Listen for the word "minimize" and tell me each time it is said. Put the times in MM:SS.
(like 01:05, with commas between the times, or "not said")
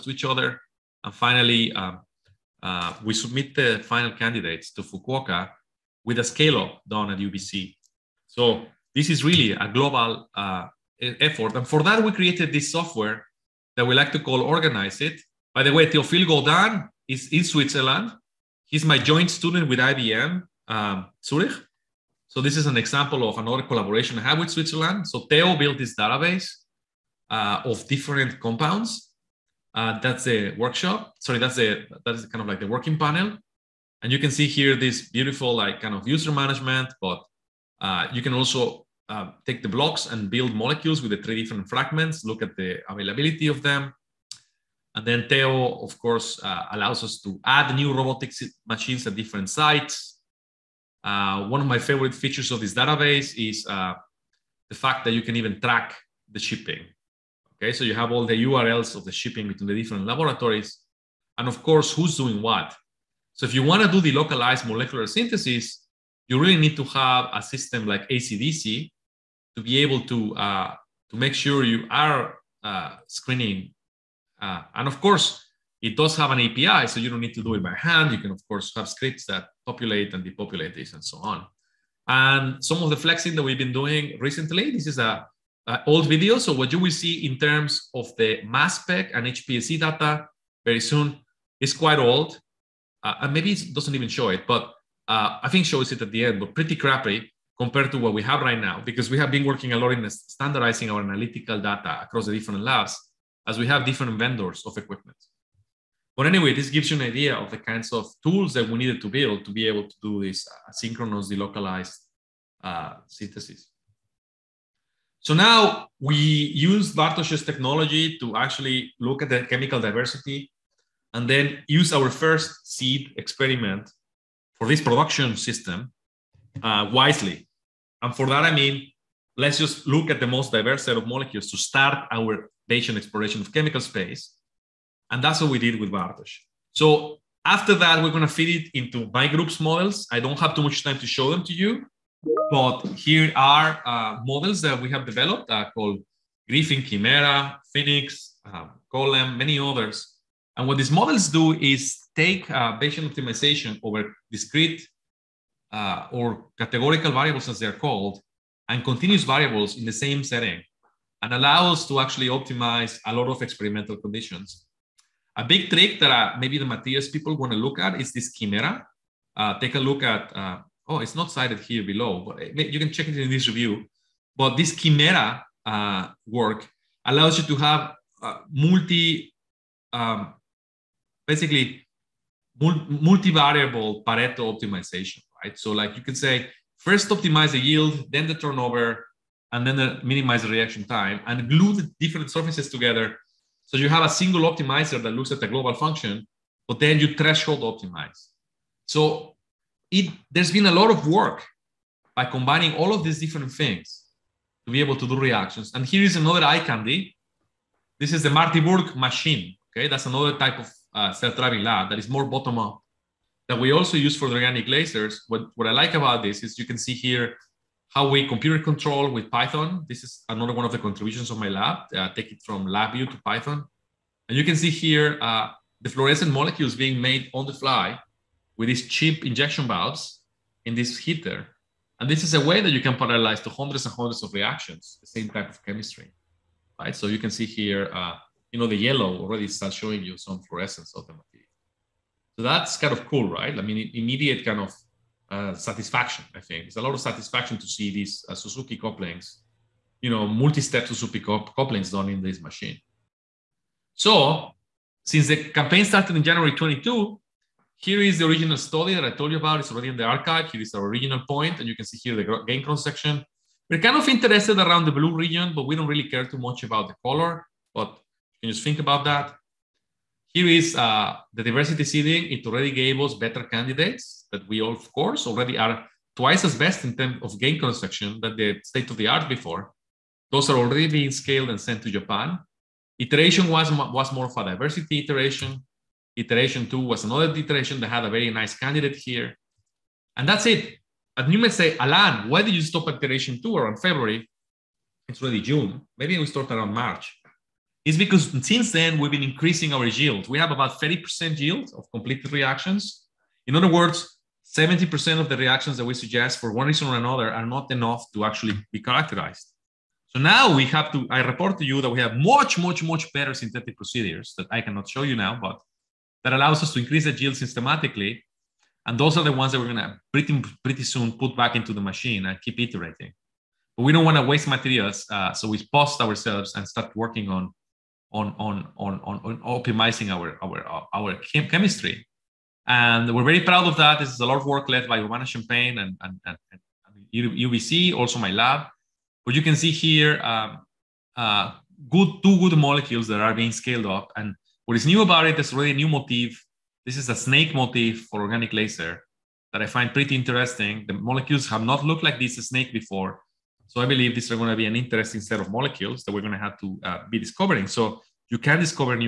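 03:10.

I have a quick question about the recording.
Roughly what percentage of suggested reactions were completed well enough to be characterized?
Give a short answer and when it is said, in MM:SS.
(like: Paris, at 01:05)
30%, at 05:00.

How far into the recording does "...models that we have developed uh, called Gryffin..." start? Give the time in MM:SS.
02:24.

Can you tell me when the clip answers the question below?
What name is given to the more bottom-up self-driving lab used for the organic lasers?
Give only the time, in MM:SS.
03:28.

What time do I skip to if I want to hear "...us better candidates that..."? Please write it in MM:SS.
04:32.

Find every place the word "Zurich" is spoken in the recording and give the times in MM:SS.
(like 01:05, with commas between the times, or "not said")
00:21.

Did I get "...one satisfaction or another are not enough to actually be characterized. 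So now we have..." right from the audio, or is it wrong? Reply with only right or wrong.
wrong.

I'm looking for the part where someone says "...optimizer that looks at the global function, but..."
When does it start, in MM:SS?
03:14.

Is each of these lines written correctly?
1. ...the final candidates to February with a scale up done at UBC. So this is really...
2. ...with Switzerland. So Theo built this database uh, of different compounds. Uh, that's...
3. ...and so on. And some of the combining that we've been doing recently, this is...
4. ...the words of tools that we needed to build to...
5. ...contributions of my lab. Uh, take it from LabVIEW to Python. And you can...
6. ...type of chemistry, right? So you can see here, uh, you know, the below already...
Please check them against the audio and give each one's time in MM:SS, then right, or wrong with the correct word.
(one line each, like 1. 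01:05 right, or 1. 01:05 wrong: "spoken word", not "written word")
1. 00:03 wrong: "Fukuoka", not "February"
2. 00:24 right
3. 01:20 wrong: "flexing", not "combining"
4. 01:47 wrong: "kinds", not "words"
5. 03:40 right
6. 03:55 wrong: "yellow", not "below".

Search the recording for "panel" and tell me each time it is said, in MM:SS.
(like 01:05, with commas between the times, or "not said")
00:32.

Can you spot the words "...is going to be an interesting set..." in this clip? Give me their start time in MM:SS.
05:54.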